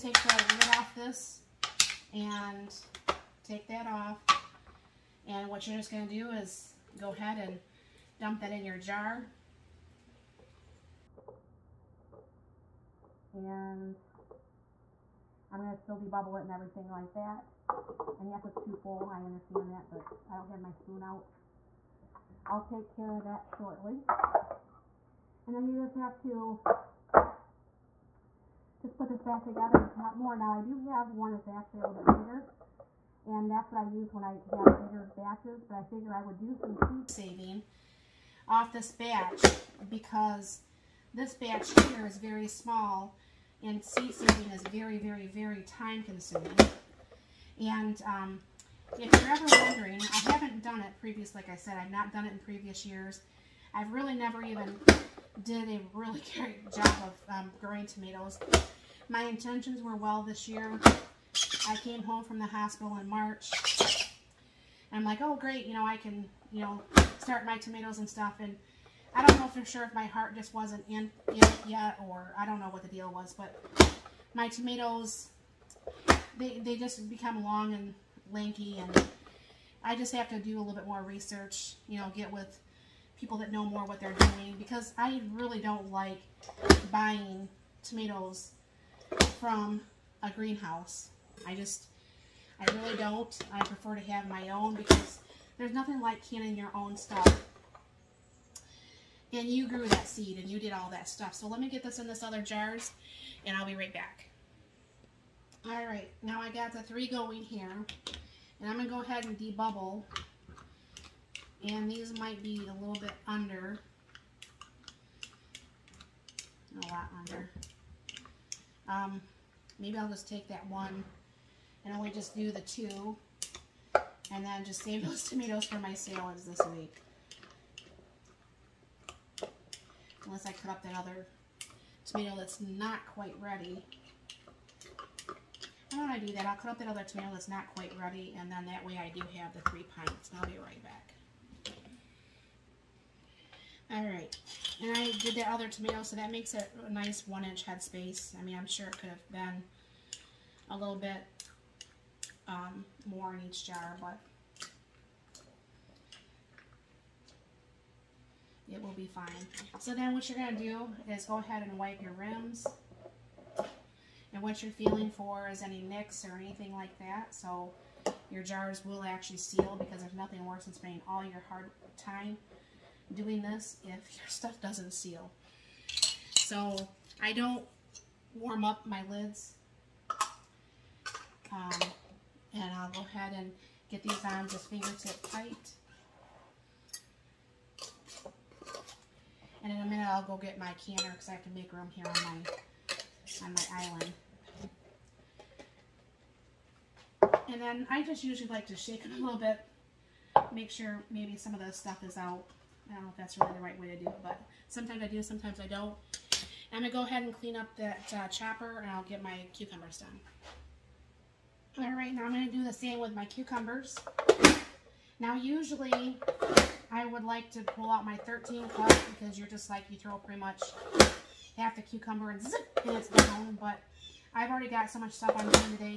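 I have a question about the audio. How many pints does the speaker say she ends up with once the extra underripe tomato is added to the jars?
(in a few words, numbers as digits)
3.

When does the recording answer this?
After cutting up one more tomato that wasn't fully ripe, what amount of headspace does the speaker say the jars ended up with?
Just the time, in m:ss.
2:27.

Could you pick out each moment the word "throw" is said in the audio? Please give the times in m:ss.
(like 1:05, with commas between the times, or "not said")
3:39.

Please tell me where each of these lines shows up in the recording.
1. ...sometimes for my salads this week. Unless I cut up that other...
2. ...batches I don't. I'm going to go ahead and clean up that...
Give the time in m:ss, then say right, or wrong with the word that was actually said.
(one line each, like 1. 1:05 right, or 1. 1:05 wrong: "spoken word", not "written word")
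1. 2:05 wrong: "tomatoes", not "sometimes"
2. 3:25 wrong: "sometimes", not "batches".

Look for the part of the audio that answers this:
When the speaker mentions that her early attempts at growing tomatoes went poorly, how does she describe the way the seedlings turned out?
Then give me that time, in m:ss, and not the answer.
1:17.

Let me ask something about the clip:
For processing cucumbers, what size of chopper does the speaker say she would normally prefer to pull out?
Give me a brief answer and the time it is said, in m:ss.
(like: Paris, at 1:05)
13 cup, at 3:38.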